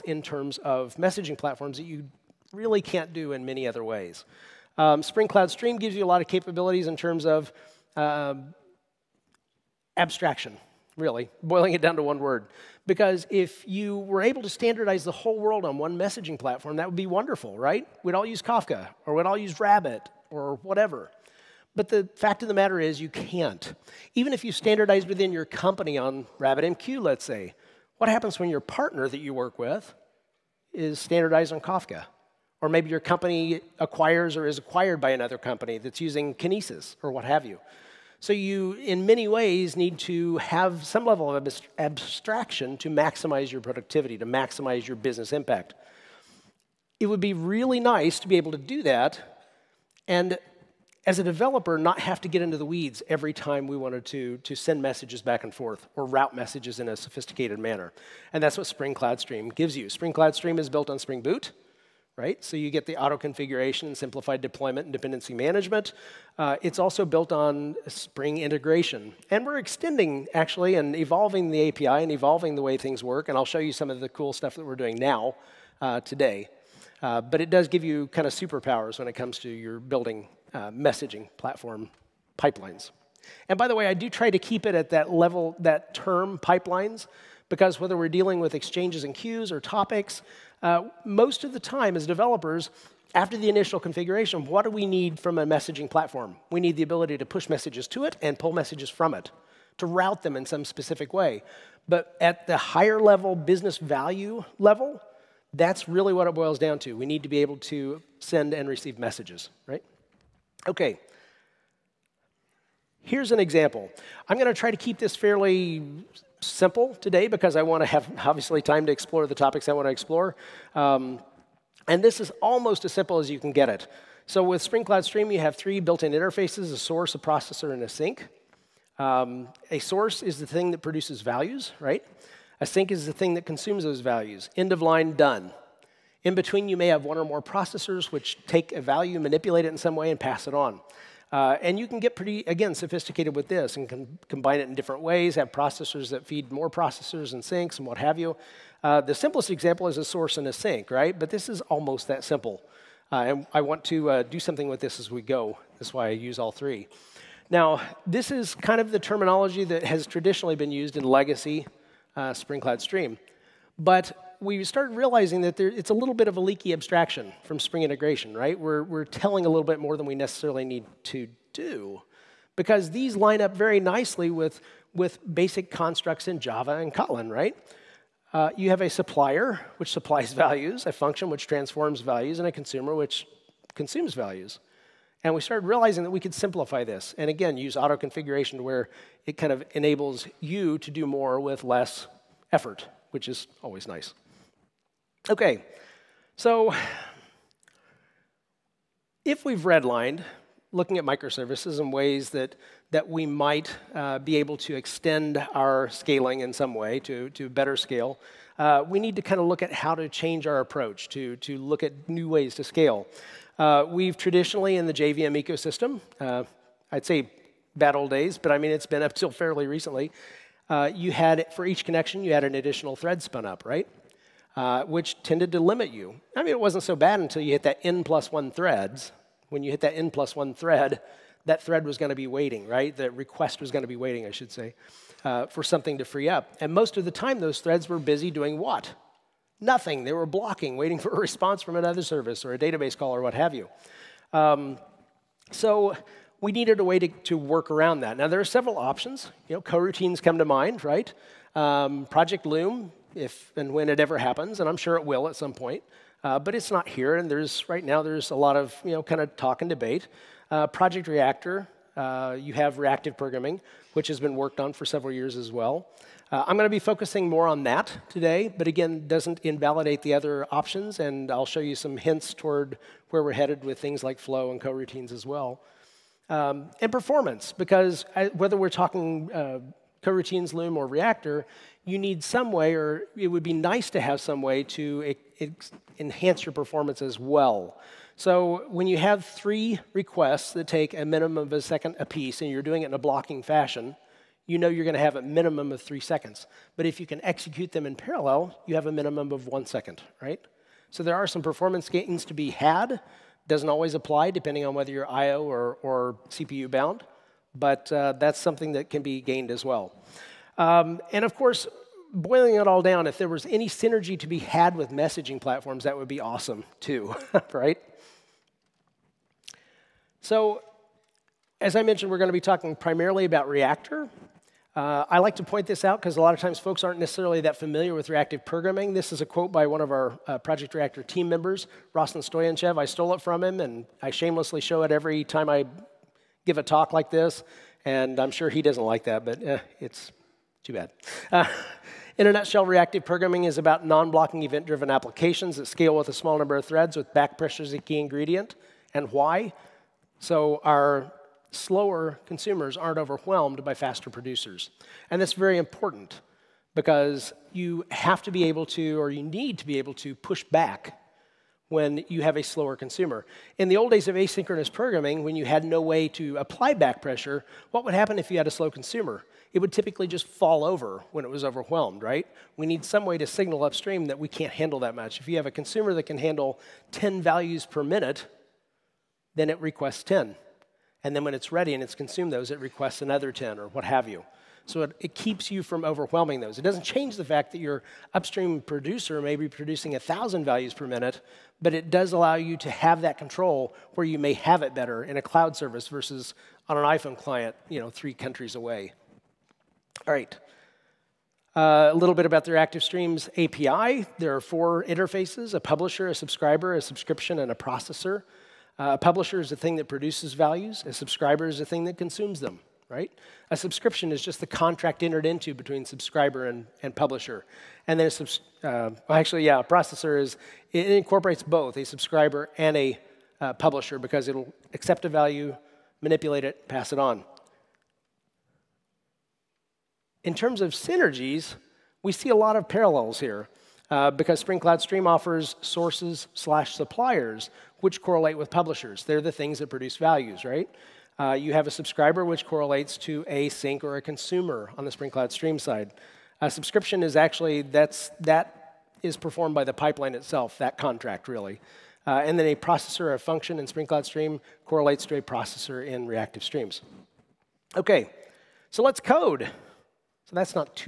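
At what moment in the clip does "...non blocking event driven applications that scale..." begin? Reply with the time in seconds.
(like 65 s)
343 s.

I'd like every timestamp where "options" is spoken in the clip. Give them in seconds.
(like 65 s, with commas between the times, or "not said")
248 s, 270 s.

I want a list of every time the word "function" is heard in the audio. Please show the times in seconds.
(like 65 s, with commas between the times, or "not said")
180 s, 453 s.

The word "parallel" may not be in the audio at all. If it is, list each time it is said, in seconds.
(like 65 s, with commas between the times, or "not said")
297 s, 432 s.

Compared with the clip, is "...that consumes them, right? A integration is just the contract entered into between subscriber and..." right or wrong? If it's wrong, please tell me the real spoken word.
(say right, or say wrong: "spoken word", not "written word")
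wrong: "subscription", not "integration".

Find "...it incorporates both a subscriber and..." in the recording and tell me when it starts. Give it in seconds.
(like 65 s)
420 s.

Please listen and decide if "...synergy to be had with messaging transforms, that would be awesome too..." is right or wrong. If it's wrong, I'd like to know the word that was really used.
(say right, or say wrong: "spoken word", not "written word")
wrong: "platforms", not "transforms".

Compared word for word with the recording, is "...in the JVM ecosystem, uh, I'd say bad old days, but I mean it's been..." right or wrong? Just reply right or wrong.
right.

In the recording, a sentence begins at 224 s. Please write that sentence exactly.
Uh, which tended to limit you.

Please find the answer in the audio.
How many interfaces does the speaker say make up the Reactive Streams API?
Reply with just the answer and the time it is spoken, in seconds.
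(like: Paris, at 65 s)
4, at 404 s.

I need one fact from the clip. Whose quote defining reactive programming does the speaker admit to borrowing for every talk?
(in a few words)
Rossen Stoyanchev.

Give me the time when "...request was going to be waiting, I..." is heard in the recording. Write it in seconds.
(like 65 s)
233 s.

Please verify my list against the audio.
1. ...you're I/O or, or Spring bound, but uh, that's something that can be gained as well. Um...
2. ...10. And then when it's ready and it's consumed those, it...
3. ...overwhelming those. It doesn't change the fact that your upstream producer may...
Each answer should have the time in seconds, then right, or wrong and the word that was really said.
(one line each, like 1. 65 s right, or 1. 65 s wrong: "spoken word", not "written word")
1. 304 s wrong: "CPU", not "Spring"
2. 380 s right
3. 385 s right.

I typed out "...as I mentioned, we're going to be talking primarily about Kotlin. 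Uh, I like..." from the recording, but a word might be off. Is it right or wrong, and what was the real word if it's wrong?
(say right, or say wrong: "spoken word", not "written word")
wrong: "Reactor", not "Kotlin".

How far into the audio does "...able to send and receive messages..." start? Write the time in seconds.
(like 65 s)
107 s.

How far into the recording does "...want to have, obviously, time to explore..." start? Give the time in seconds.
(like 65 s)
117 s.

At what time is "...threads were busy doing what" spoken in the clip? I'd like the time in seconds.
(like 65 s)
237 s.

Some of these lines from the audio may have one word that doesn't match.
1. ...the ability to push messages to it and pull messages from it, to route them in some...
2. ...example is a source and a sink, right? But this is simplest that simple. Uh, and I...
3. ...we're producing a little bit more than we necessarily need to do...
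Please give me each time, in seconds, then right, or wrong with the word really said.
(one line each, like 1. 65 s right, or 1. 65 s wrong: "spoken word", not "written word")
1. 96 s right
2. 149 s wrong: "almost", not "simplest"
3. 168 s wrong: "telling", not "producing".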